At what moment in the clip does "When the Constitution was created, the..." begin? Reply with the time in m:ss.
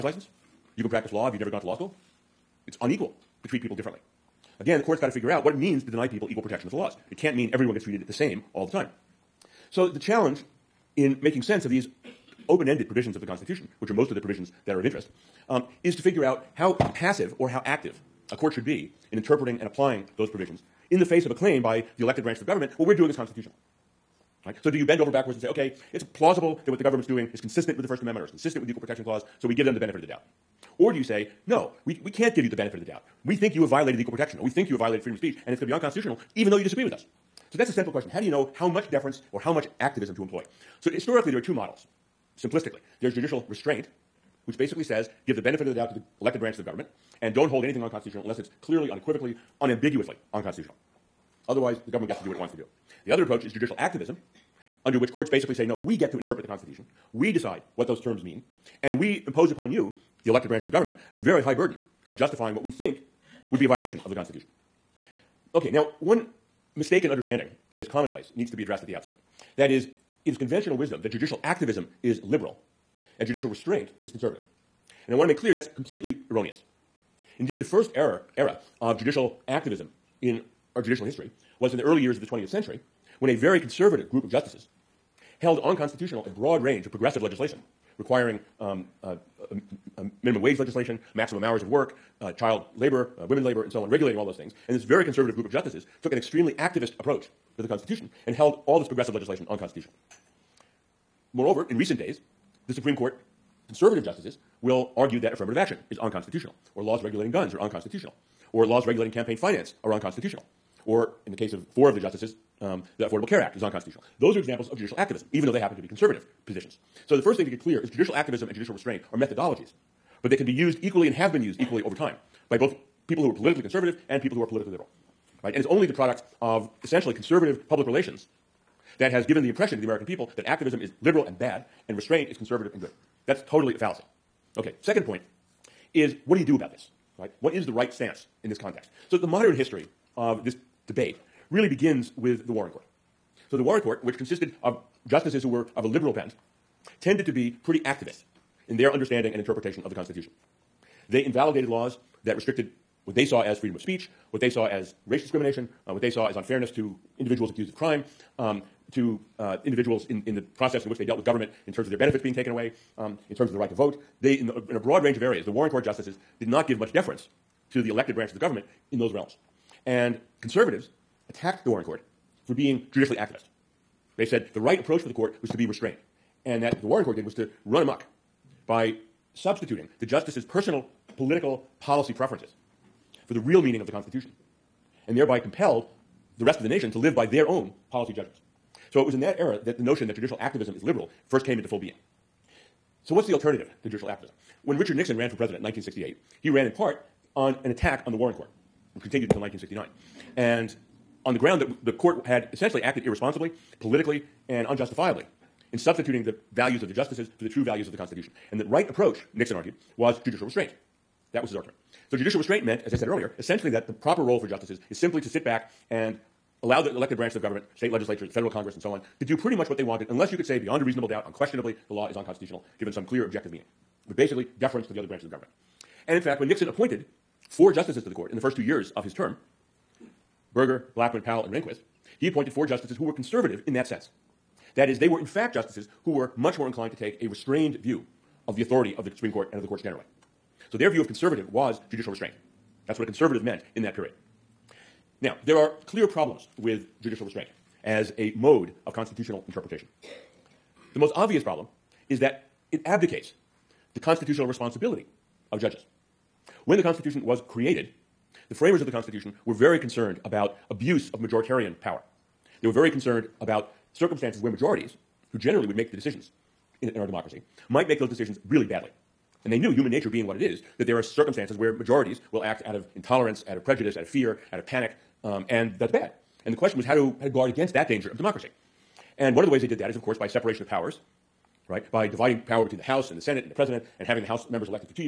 4:16.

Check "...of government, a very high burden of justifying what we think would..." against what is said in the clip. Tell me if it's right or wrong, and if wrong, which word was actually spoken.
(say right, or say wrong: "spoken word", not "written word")
right.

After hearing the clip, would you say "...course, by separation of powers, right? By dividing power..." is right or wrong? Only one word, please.
right.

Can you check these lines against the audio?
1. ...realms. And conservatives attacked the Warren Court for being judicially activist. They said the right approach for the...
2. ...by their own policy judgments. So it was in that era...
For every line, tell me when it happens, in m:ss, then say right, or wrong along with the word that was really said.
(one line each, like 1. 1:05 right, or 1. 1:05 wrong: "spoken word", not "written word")
1. 2:49 right
2. 3:07 right.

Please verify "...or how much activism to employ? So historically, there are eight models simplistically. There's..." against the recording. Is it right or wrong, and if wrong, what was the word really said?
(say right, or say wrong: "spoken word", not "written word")
wrong: "two", not "eight".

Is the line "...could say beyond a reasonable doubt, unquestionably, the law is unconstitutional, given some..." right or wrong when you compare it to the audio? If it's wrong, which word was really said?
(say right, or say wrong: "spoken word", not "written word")
right.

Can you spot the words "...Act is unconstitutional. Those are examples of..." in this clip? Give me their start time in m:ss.
1:53.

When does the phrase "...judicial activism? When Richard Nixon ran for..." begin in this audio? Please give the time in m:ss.
3:13.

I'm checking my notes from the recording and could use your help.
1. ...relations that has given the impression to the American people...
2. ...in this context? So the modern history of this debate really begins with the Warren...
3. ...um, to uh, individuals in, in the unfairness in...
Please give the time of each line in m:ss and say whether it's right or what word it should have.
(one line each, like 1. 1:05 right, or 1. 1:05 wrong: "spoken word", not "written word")
1. 2:07 right
2. 2:18 right
3. 2:38 wrong: "process", not "unfairness".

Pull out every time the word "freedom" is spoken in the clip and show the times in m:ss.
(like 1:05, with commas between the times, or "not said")
0:35, 2:33.